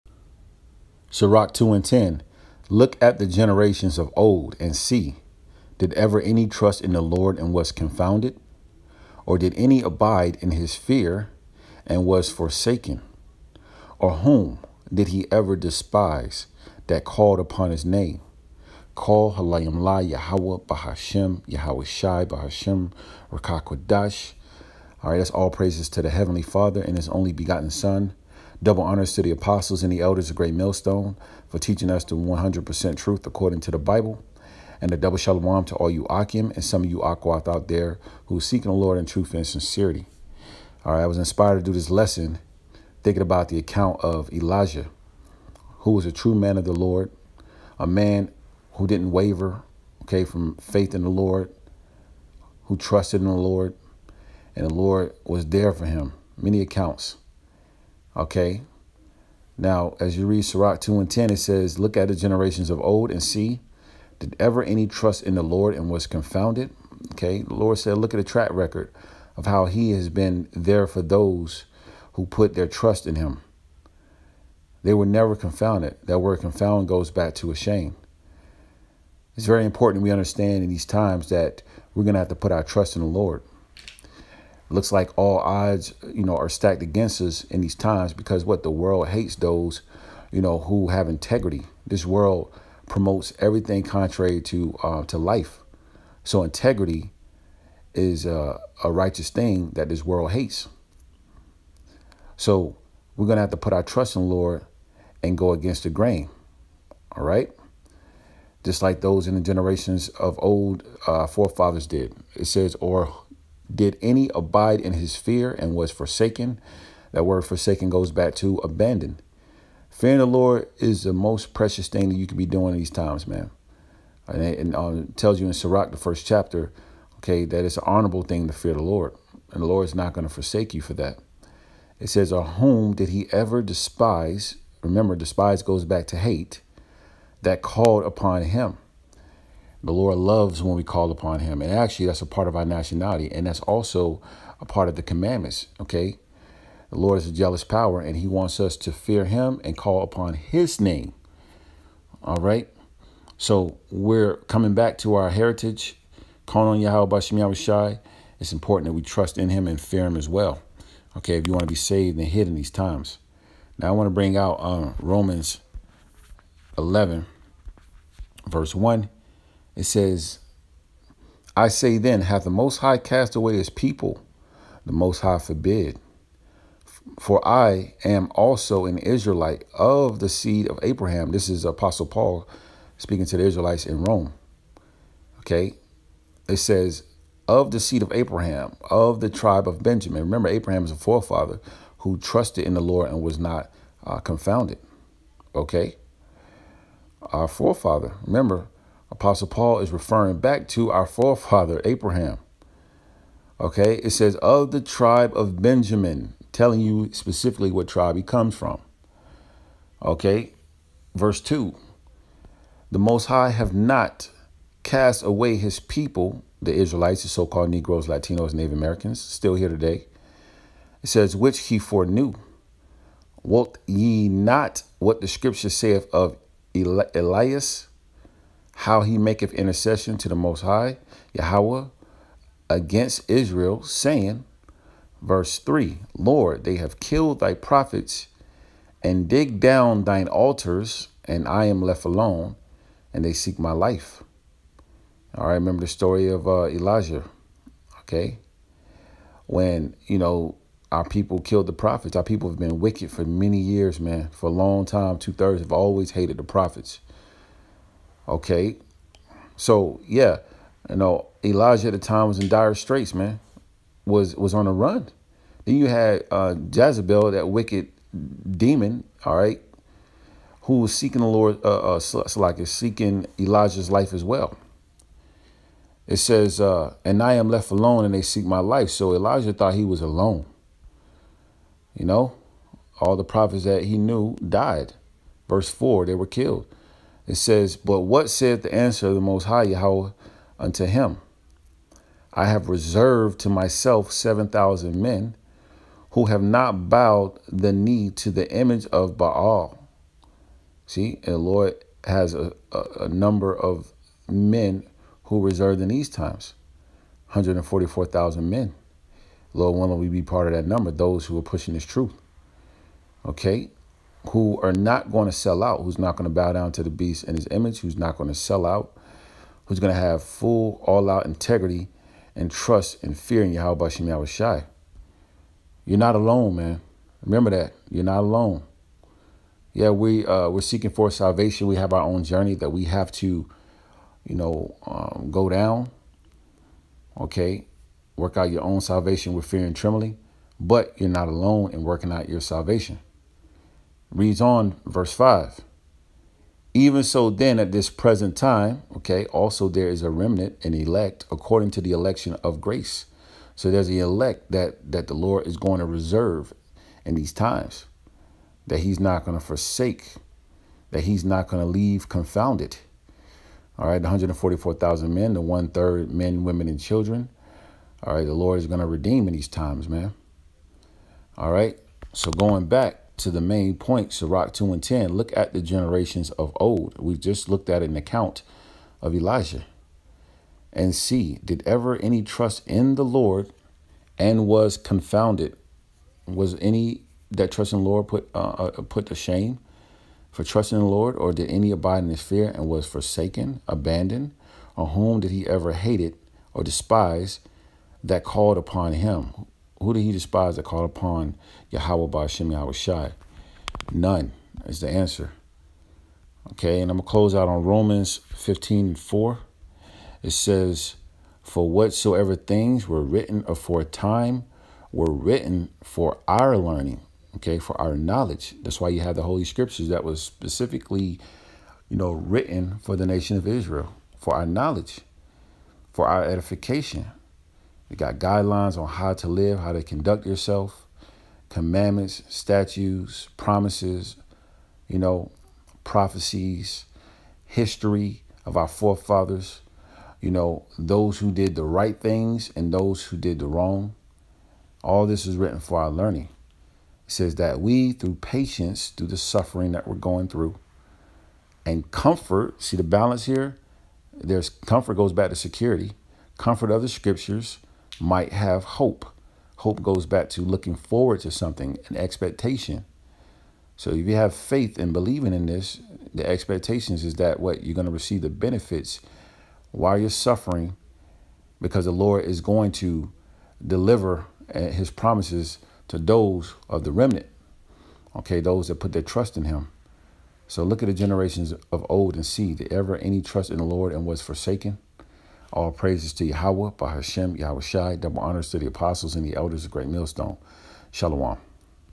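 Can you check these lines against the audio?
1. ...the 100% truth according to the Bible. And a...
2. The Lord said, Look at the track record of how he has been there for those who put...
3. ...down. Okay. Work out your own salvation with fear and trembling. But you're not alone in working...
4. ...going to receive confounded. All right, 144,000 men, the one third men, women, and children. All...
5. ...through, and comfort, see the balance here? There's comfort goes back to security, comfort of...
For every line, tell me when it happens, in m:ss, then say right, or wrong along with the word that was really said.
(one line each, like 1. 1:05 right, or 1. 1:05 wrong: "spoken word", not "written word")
1. 0:32 right
2. 1:07 right
3. 5:35 right
4. 6:01 wrong: "leave", not "receive"
5. 7:30 right.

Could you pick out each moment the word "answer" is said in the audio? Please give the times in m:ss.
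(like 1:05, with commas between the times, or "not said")
4:48, 6:44.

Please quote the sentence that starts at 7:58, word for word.
Okay, those that put their trust in him.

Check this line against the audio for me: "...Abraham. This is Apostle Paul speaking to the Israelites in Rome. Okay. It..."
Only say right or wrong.
right.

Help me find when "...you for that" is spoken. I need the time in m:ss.
2:10.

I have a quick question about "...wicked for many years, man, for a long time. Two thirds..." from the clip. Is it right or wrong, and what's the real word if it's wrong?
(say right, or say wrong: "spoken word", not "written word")
right.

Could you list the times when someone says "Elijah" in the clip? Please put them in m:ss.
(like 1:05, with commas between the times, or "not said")
0:44, 4:06, 4:21, 4:33, 4:39, 6:19.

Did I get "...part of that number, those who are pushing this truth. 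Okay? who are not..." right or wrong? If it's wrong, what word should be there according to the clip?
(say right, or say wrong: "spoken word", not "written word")
right.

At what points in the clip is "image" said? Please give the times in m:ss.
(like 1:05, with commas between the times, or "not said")
4:58, 5:17.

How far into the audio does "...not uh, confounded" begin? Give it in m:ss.
3:13.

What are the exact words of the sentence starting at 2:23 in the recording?
And that's also a part of the commandments, okay?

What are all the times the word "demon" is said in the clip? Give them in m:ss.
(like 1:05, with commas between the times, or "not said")
4:28.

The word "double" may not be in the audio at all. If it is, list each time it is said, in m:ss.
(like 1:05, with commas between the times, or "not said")
0:28, 0:34, 8:07.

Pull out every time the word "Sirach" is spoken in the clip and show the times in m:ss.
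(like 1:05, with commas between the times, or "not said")
0:01, 1:00, 2:05, 6:14.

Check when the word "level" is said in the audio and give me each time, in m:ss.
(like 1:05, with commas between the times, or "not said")
not said.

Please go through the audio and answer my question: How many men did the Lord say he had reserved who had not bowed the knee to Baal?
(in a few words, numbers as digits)
7,000.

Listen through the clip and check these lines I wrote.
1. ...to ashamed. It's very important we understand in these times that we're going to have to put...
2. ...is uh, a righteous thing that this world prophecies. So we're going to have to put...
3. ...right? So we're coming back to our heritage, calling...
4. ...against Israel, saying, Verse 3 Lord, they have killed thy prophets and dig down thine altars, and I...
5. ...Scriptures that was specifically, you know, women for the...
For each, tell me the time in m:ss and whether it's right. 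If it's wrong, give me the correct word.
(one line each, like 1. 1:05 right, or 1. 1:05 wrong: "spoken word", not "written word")
1. 1:17 right
2. 1:37 wrong: "hates", not "prophecies"
3. 2:32 right
4. 3:52 right
5. 6:59 wrong: "written", not "women".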